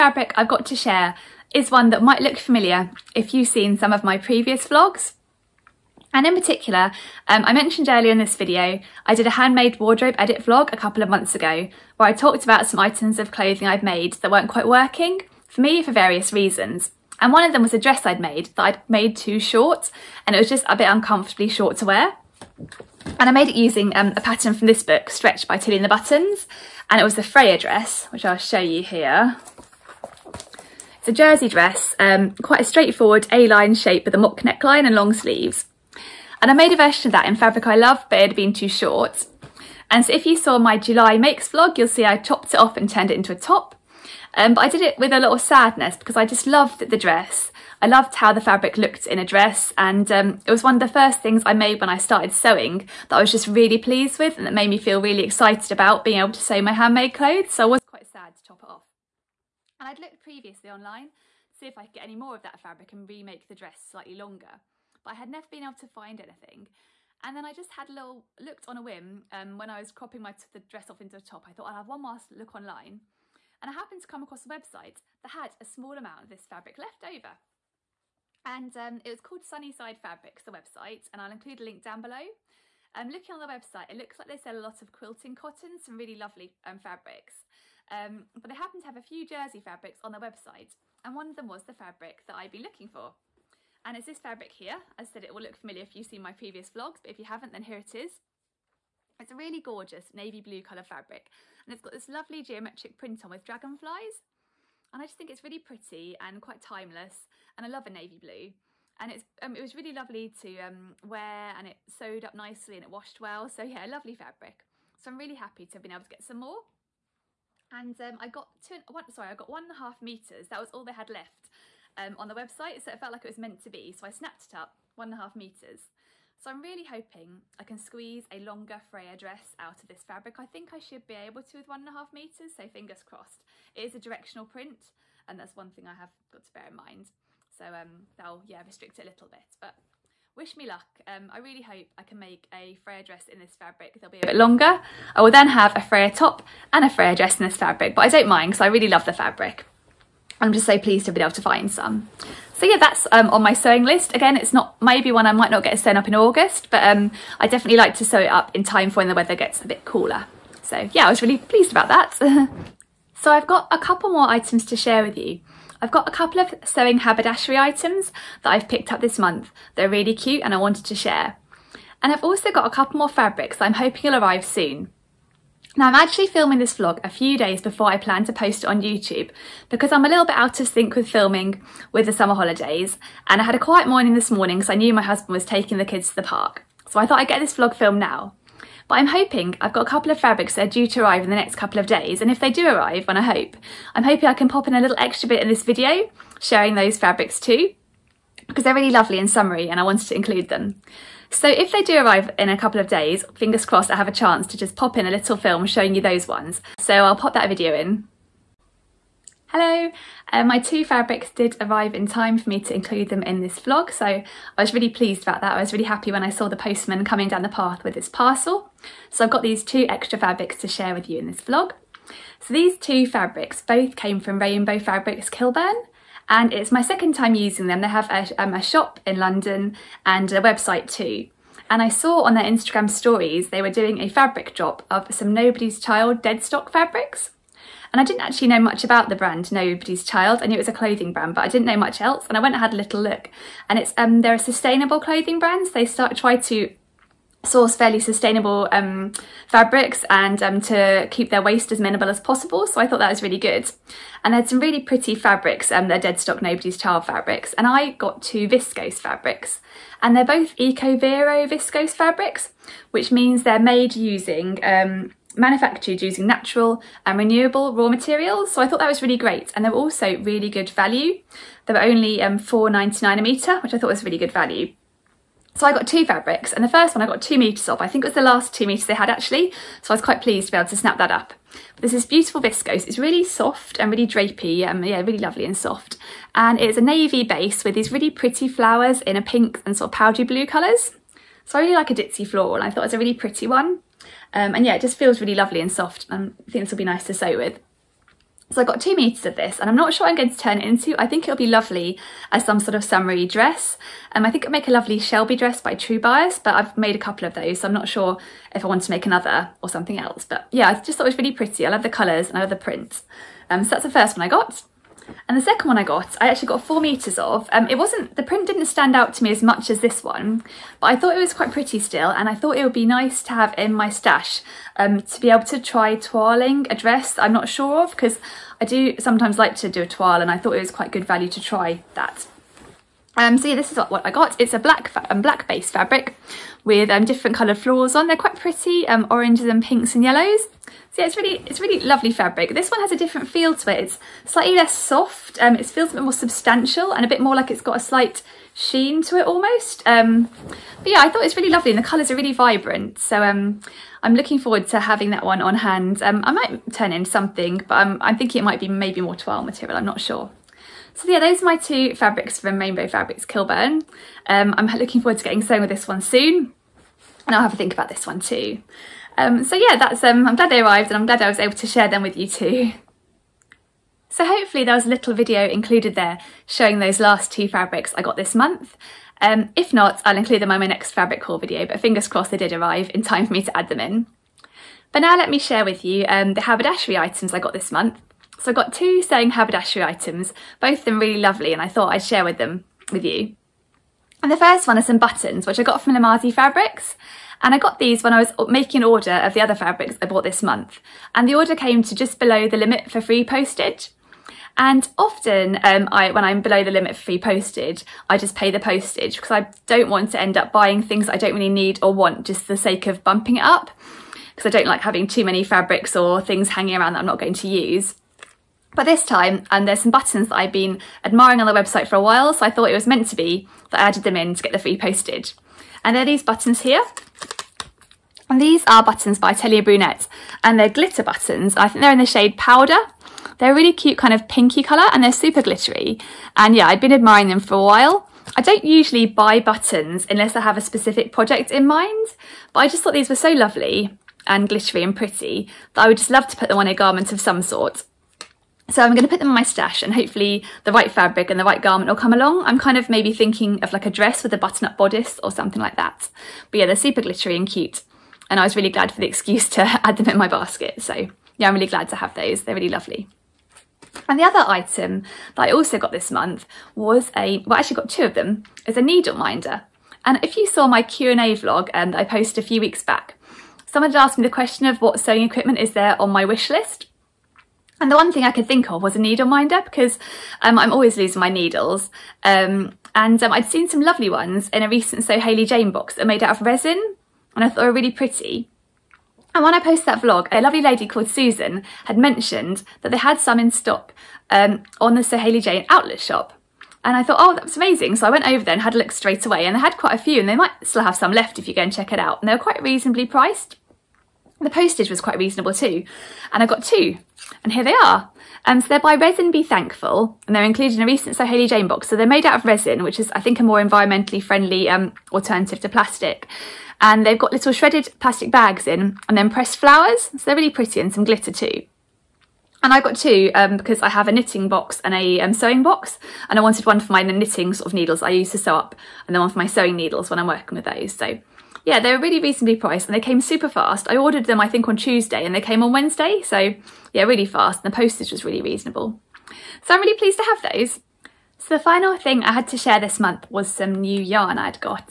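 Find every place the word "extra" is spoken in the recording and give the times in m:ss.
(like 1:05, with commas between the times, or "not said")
3:14, 3:39.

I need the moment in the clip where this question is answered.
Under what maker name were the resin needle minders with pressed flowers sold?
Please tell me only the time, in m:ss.
8:28.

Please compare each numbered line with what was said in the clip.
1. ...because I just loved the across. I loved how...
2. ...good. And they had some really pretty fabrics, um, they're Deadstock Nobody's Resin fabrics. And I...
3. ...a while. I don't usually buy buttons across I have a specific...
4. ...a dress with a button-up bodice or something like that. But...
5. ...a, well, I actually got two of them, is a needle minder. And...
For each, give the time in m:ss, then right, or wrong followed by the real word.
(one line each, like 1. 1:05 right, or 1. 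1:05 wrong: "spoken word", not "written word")
1. 0:45 wrong: "dress", not "across"
2. 4:13 wrong: "Child", not "Resin"
3. 7:17 wrong: "unless", not "across"
4. 7:33 right
5. 7:47 right.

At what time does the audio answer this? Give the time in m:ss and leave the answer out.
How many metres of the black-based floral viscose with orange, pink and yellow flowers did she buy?
5:16.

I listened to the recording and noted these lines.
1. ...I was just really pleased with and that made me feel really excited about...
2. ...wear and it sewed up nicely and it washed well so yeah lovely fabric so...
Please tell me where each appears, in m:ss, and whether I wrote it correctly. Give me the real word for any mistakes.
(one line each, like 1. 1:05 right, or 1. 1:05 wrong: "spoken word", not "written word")
1. 0:53 right
2. 1:51 right.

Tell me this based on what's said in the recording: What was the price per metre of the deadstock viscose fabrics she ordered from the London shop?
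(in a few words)
4.99.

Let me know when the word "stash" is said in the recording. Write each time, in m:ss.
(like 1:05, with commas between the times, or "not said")
5:23, 7:29.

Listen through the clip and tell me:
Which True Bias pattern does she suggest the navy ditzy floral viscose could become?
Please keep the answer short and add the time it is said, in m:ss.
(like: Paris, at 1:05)
Shelby dress, at 5:04.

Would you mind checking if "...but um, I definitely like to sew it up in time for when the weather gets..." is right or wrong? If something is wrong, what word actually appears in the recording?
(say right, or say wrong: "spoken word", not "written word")
right.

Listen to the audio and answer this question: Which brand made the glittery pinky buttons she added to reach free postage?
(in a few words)
Atelier Brunette.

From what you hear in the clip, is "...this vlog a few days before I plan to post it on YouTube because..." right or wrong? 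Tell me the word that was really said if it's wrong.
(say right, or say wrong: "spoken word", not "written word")
right.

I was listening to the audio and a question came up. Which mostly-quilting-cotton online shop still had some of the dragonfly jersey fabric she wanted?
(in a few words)
Sunnyside Fabrics.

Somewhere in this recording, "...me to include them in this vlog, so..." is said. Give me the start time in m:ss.
3:32.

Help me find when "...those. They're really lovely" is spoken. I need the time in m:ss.
7:42.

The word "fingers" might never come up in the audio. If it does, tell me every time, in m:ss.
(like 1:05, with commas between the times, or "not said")
2:12, 3:23, 6:21.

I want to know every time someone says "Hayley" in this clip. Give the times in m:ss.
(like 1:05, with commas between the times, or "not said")
8:05, 8:15, 8:31.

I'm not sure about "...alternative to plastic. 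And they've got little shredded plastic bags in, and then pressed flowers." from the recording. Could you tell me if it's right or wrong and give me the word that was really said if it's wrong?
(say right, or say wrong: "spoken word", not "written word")
right.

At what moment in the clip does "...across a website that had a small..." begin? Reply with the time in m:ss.
1:14.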